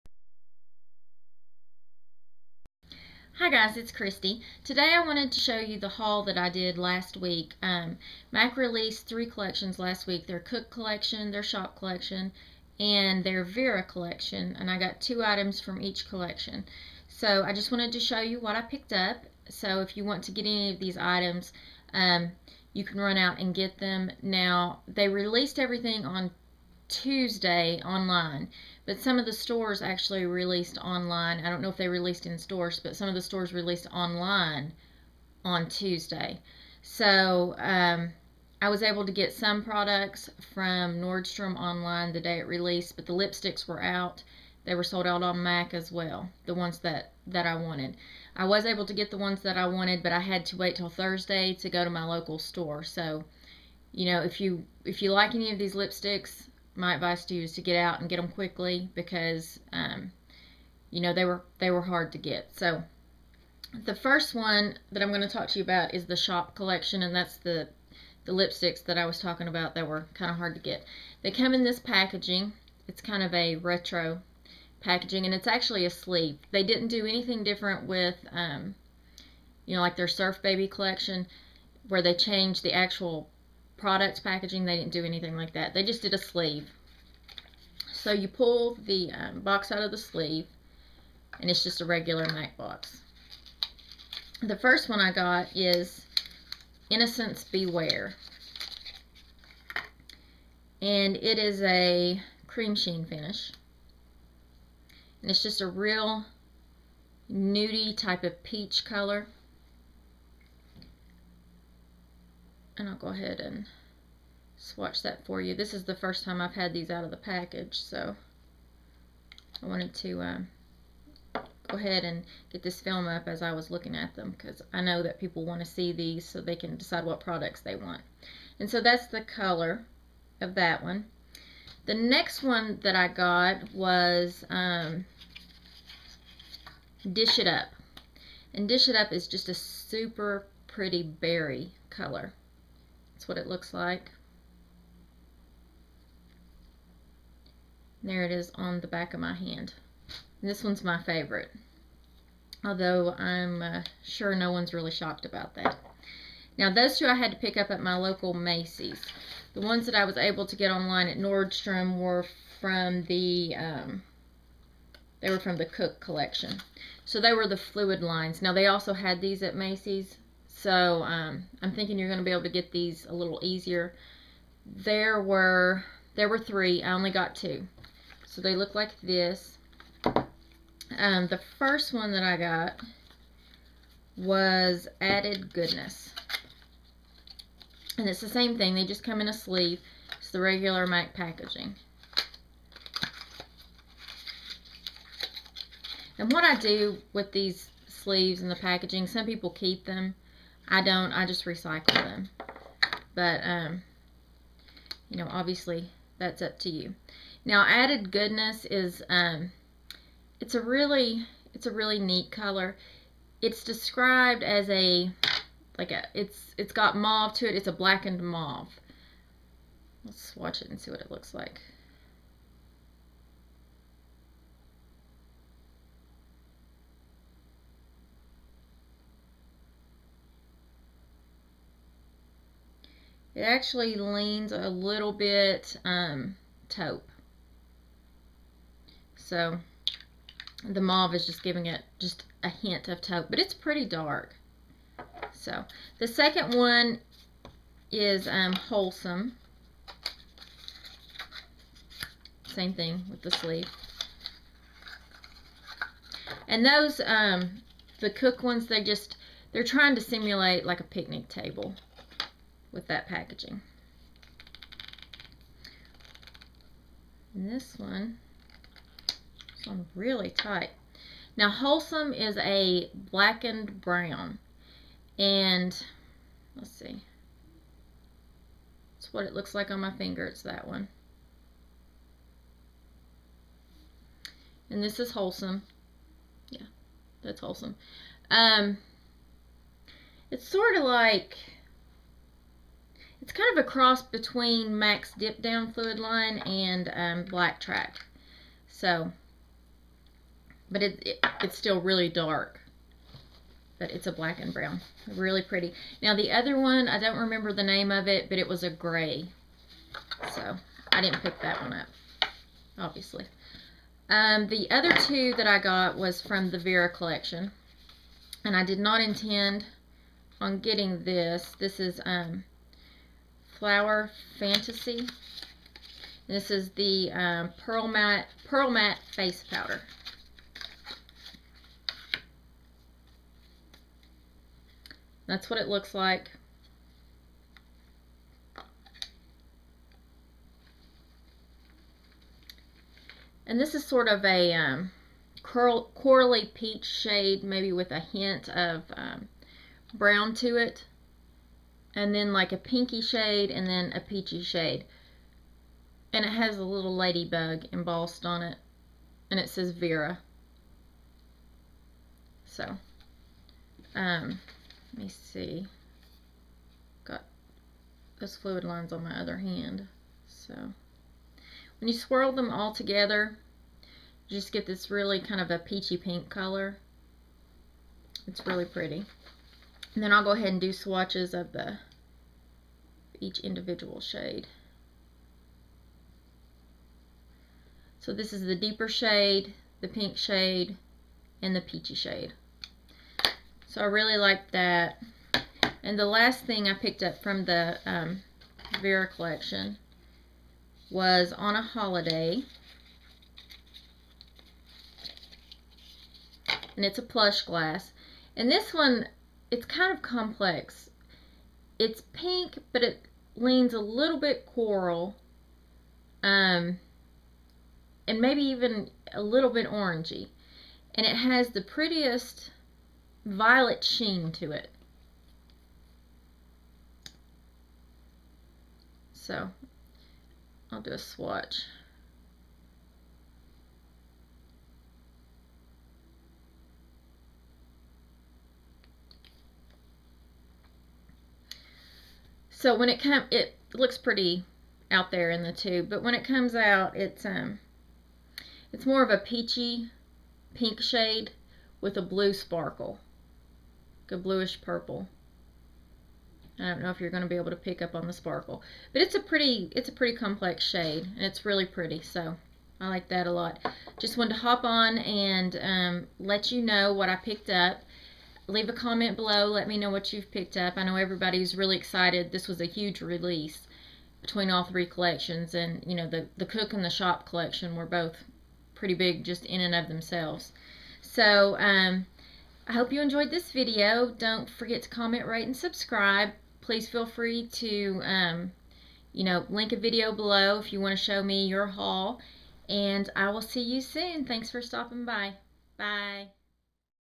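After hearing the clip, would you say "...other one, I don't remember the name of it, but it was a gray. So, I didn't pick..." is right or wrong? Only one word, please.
right.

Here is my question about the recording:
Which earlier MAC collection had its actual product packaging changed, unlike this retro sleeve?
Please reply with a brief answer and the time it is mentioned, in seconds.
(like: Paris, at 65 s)
Surf Baby, at 80 s.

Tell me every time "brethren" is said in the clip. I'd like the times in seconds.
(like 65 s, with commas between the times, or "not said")
not said.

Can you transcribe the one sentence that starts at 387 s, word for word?
So this is the deeper shade, the pink shade, and the peachy shade.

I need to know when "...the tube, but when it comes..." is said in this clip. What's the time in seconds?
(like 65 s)
445 s.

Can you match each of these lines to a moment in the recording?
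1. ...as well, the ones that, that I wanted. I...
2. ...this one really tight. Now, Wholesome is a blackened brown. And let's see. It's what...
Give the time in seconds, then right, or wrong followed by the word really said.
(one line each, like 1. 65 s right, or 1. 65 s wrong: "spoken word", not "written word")
1. 45 s right
2. 269 s right.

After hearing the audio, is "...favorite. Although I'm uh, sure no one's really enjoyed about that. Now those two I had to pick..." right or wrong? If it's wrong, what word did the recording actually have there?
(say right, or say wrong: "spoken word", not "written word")
wrong: "shocked", not "enjoyed".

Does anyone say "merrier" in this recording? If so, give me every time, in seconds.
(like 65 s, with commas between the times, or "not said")
not said.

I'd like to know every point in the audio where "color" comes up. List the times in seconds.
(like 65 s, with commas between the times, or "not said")
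108 s, 129 s, 141 s, 212 s, 376 s.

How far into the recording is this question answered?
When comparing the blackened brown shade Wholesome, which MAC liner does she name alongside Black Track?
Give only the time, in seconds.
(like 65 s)
295 s.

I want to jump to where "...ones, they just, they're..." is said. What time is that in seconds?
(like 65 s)
258 s.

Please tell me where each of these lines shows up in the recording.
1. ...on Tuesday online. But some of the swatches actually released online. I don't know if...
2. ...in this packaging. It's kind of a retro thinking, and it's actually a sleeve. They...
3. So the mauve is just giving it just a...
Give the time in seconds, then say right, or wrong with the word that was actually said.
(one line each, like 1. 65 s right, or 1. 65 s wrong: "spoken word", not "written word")
1. 26 s wrong: "stores", not "swatches"
2. 71 s wrong: "packaging", not "thinking"
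3. 239 s right.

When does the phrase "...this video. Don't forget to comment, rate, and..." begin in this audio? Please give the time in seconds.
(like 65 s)
483 s.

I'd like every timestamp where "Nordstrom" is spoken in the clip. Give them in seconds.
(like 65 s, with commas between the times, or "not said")
40 s, 161 s.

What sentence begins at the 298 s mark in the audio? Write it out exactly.
So, but it, it, it's still really dark.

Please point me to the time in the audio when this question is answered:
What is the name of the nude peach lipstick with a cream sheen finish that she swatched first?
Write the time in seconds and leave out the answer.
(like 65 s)
96 s.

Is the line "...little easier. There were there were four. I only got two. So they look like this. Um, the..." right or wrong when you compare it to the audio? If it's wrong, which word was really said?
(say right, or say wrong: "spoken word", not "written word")
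wrong: "three", not "four".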